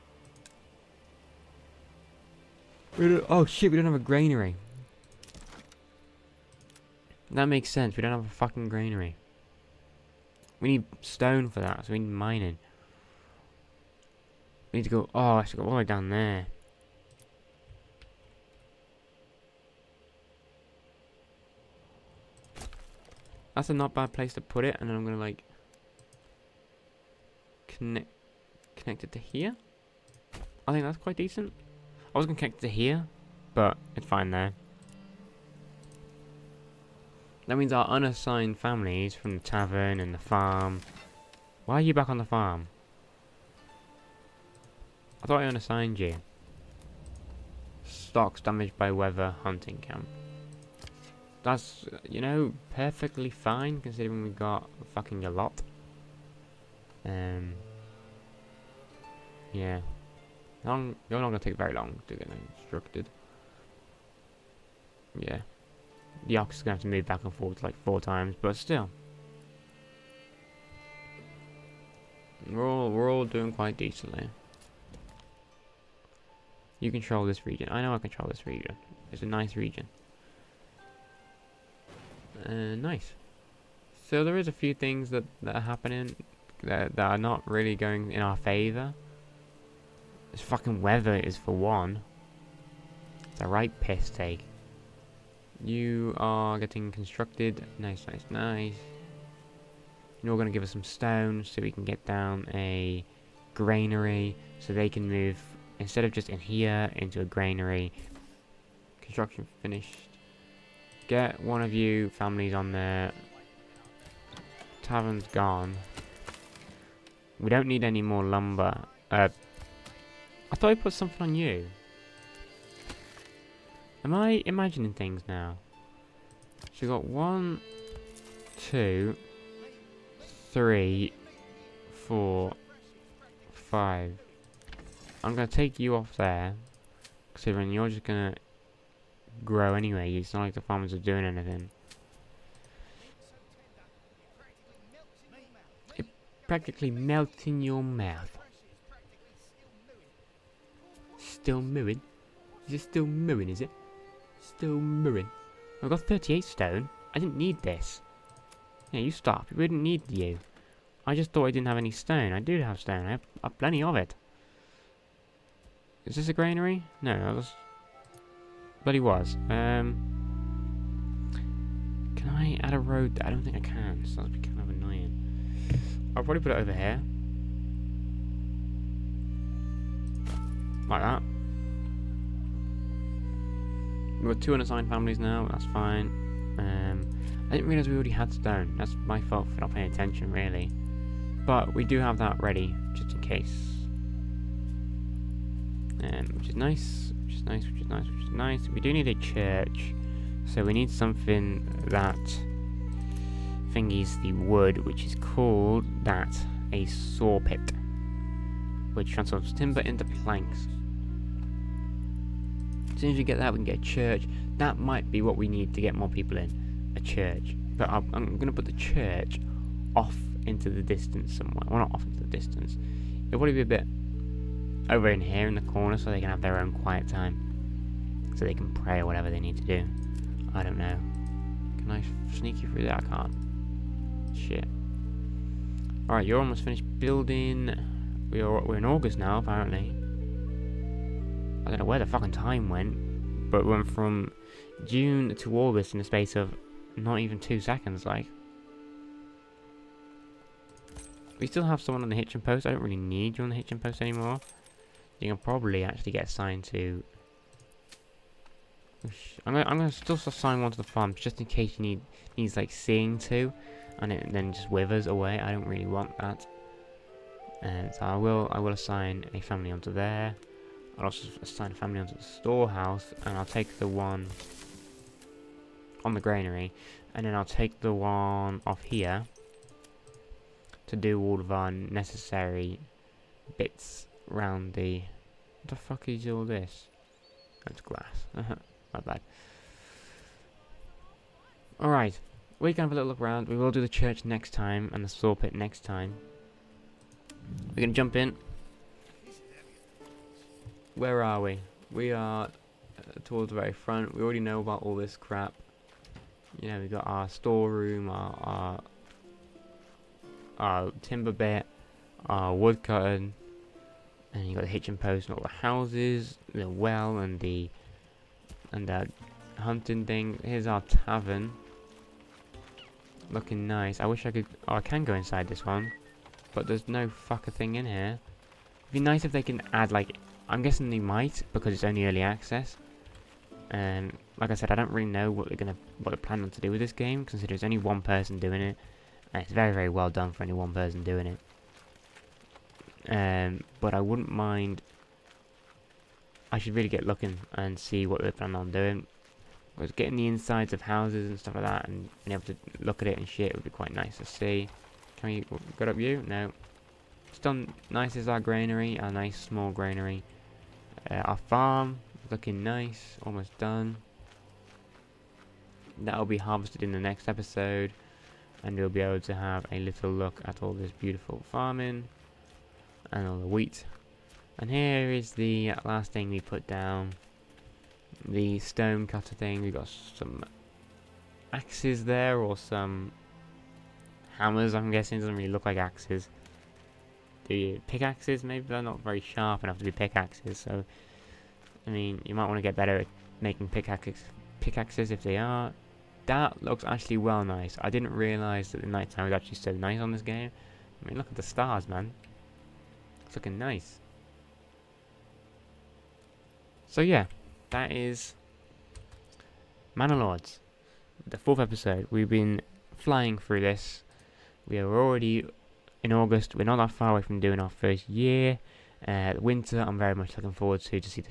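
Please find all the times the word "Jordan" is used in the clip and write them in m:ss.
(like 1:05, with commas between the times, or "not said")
not said.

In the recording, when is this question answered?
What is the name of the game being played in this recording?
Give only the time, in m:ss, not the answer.
6:49.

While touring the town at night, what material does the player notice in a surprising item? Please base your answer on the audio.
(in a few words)
glass.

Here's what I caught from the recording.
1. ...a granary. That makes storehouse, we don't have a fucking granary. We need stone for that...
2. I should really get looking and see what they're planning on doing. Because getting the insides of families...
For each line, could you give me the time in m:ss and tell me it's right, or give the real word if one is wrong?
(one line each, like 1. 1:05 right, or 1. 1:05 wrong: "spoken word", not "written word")
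1. 0:03 wrong: "sense", not "storehouse"
2. 5:46 wrong: "houses", not "families".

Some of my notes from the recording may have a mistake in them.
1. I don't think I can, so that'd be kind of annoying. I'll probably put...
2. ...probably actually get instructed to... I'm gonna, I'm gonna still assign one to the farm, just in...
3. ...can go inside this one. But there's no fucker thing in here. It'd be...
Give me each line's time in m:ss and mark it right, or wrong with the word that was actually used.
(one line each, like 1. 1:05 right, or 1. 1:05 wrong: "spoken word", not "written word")
1. 2:53 right
2. 4:15 wrong: "assigned", not "instructed"
3. 5:24 right.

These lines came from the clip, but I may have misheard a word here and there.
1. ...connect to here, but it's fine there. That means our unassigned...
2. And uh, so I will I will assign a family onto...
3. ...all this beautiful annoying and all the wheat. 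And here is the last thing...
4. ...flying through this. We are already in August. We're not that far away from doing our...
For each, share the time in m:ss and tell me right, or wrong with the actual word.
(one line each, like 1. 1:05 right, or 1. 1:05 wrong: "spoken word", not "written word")
1. 0:32 right
2. 4:27 right
3. 6:10 wrong: "farming", not "annoying"
4. 6:52 right.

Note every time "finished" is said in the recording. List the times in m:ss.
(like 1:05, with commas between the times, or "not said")
1:49, 3:56.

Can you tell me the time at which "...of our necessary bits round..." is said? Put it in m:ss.
4:41.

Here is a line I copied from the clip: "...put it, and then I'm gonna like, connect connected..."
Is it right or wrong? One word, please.
right.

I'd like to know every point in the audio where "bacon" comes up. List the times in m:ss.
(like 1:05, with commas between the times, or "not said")
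not said.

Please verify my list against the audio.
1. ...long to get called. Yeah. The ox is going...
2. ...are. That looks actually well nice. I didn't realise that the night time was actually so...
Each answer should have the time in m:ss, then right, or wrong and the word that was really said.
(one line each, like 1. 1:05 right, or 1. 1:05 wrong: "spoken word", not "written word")
1. 1:01 wrong: "instructed", not "called"
2. 6:35 right.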